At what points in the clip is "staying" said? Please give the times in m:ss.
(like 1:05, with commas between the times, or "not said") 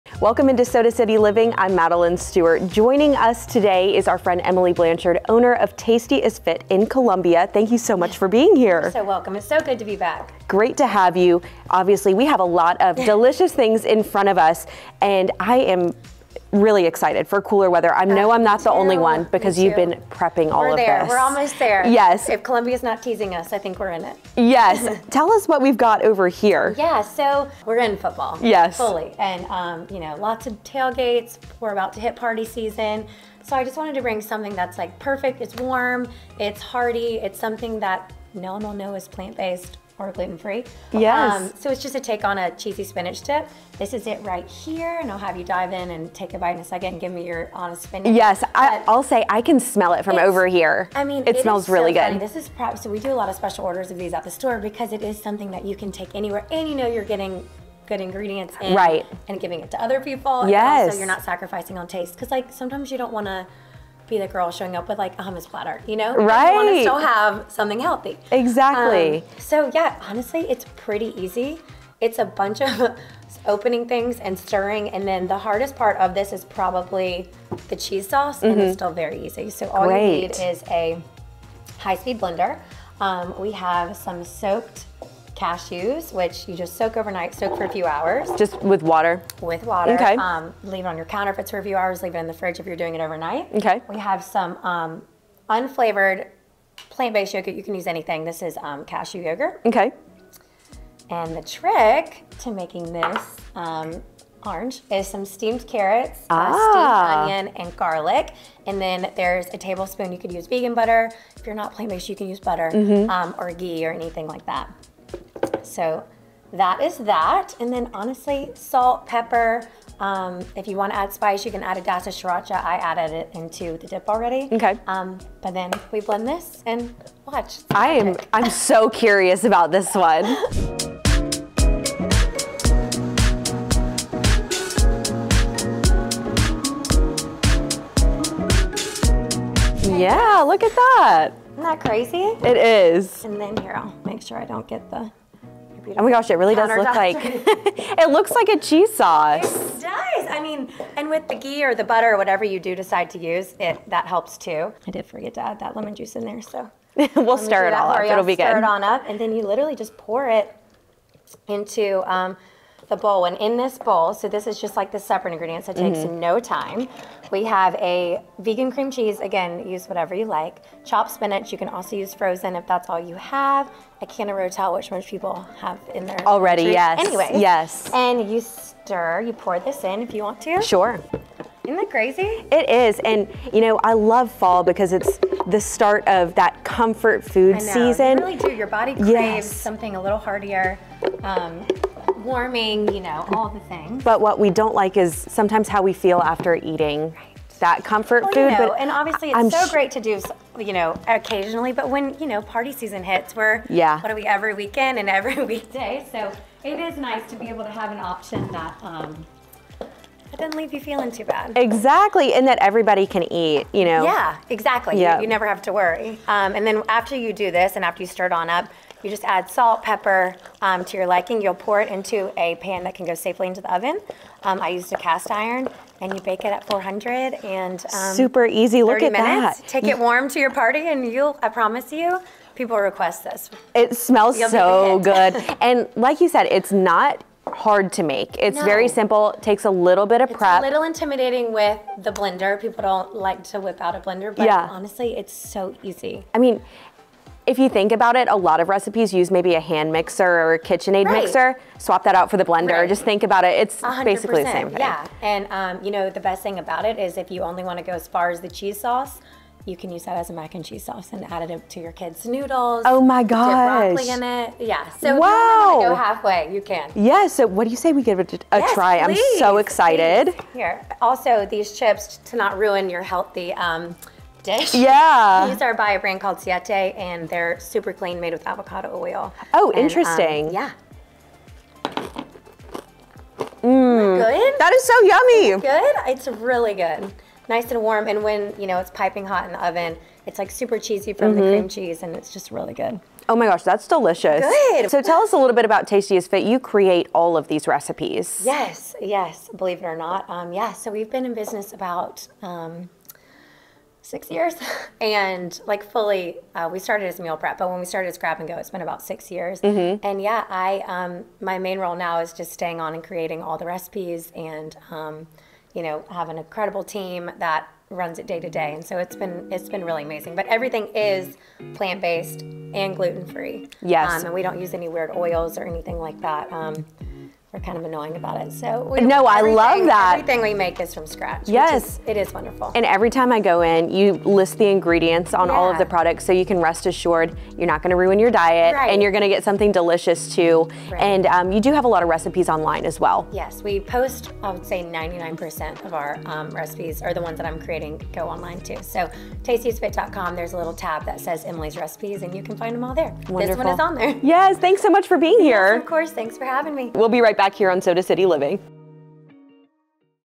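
5:12.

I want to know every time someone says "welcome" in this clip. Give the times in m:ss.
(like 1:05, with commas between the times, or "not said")
0:00, 0:09.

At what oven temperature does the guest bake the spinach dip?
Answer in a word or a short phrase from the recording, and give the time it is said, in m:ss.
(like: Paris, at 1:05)
400, at 3:46.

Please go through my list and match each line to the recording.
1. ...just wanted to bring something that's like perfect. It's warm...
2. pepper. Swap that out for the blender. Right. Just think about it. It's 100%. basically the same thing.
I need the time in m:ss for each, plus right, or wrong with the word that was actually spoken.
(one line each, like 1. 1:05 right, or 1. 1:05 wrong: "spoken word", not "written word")
1. 0:33 right
2. 4:11 wrong: "mixer", not "pepper".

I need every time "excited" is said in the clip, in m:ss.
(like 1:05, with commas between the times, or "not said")
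0:16, 4:29.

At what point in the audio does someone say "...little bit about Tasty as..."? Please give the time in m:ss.
4:55.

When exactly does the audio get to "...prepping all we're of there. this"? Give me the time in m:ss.
0:20.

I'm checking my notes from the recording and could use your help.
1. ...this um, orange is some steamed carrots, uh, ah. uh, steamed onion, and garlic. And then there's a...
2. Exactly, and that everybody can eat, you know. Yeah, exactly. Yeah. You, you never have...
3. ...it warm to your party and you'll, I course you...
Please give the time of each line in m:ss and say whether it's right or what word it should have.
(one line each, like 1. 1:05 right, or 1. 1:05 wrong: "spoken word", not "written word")
1. 1:42 right
2. 3:31 right
3. 3:49 wrong: "promise", not "course".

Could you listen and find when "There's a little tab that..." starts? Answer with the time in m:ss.
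5:50.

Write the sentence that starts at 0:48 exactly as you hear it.
Yes, I, will say I can smell it from over here.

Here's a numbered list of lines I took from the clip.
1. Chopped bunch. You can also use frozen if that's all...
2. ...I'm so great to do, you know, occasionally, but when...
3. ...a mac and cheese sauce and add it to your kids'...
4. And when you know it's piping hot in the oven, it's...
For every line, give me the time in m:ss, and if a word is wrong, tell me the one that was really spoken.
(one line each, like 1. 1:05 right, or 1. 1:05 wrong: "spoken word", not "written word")
1. 2:50 wrong: "spinach", not "bunch"
2. 3:19 right
3. 4:20 right
4. 4:48 right.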